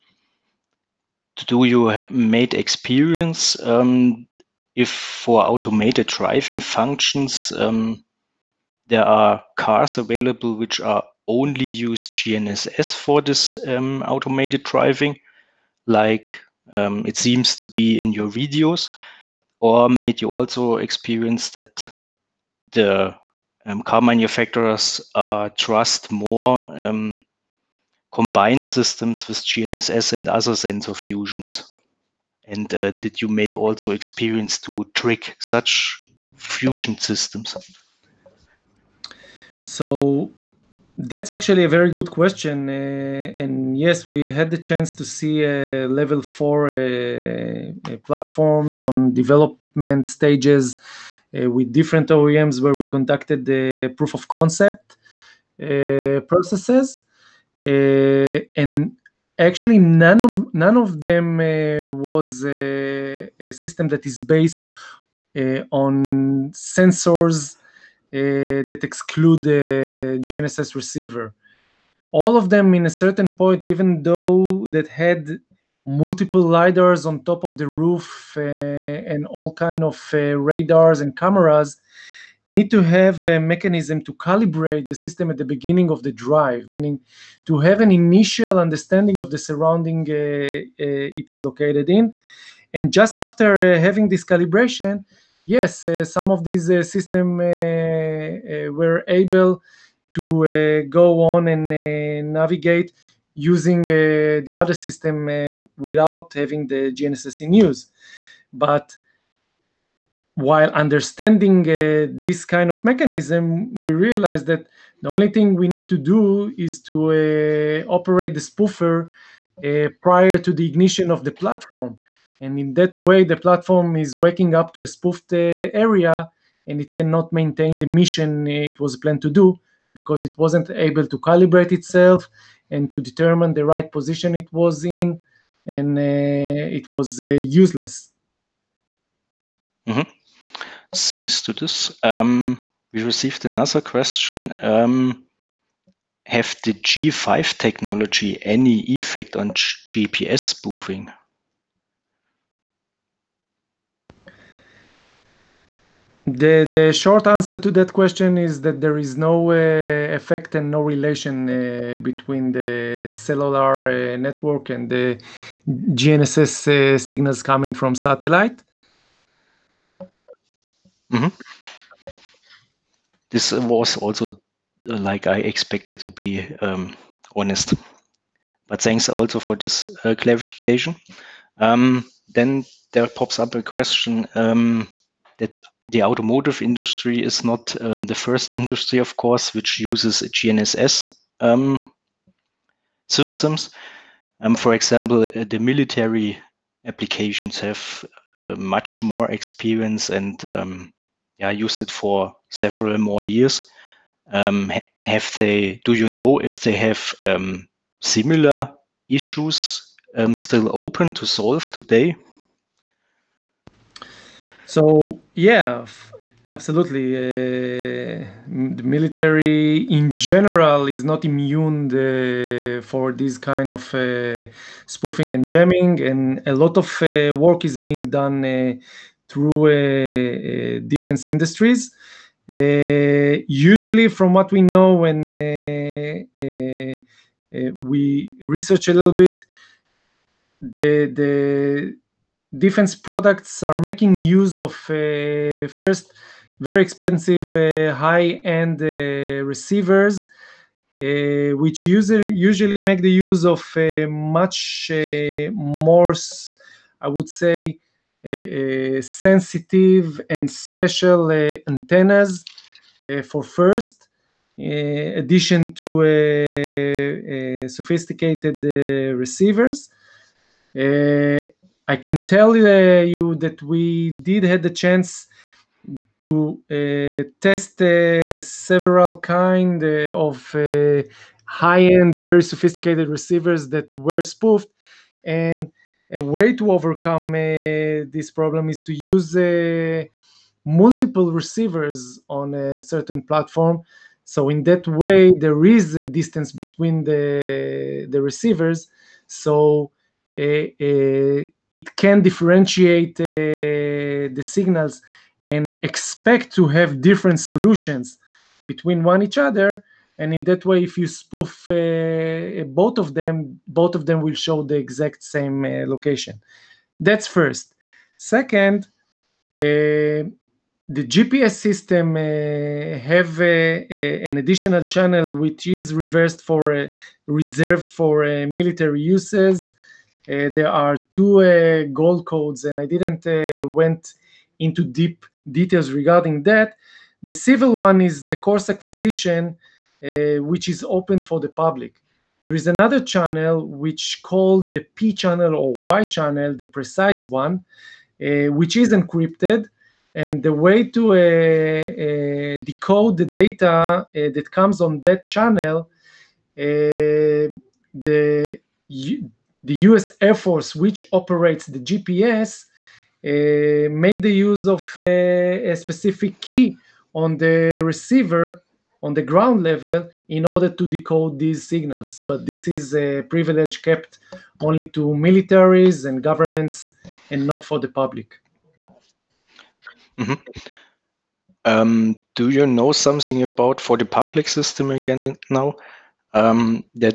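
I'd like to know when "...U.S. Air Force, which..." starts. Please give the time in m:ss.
5:59.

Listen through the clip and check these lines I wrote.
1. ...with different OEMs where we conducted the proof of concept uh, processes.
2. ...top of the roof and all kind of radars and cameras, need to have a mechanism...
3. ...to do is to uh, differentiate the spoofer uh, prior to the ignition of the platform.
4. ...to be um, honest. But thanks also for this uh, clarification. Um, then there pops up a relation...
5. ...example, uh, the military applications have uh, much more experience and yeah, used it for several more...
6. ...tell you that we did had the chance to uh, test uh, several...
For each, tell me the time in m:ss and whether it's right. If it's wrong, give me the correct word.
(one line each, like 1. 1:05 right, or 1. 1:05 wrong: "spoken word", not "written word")
1. 0:51 right
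2. 1:17 right
3. 1:55 wrong: "operate", not "differentiate"
4. 2:55 wrong: "question", not "relation"
5. 3:14 right
6. 4:32 right.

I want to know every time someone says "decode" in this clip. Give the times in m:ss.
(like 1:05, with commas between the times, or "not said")
5:52, 6:10.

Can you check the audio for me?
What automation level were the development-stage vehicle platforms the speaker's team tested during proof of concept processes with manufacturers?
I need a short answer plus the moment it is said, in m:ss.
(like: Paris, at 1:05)
Level 4, at 0:45.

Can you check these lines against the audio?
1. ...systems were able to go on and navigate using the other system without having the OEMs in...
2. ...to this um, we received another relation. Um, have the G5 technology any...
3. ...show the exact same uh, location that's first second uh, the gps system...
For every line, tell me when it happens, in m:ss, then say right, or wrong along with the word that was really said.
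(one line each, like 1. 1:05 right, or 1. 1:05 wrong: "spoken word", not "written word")
1. 1:36 wrong: "GNSS", not "OEMs"
2. 2:21 wrong: "question", not "relation"
3. 5:14 right.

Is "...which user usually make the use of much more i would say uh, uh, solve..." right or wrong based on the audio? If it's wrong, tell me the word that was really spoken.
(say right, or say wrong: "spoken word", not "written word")
wrong: "sensitive", not "solve".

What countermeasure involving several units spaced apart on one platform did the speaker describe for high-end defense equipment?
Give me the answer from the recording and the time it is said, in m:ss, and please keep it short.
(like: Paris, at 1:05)
Multiple receivers, at 4:50.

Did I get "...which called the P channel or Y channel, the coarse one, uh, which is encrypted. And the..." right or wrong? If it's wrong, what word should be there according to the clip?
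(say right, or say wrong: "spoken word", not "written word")
wrong: "precise", not "coarse".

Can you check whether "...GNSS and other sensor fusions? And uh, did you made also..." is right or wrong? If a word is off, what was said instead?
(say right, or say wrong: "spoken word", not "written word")
right.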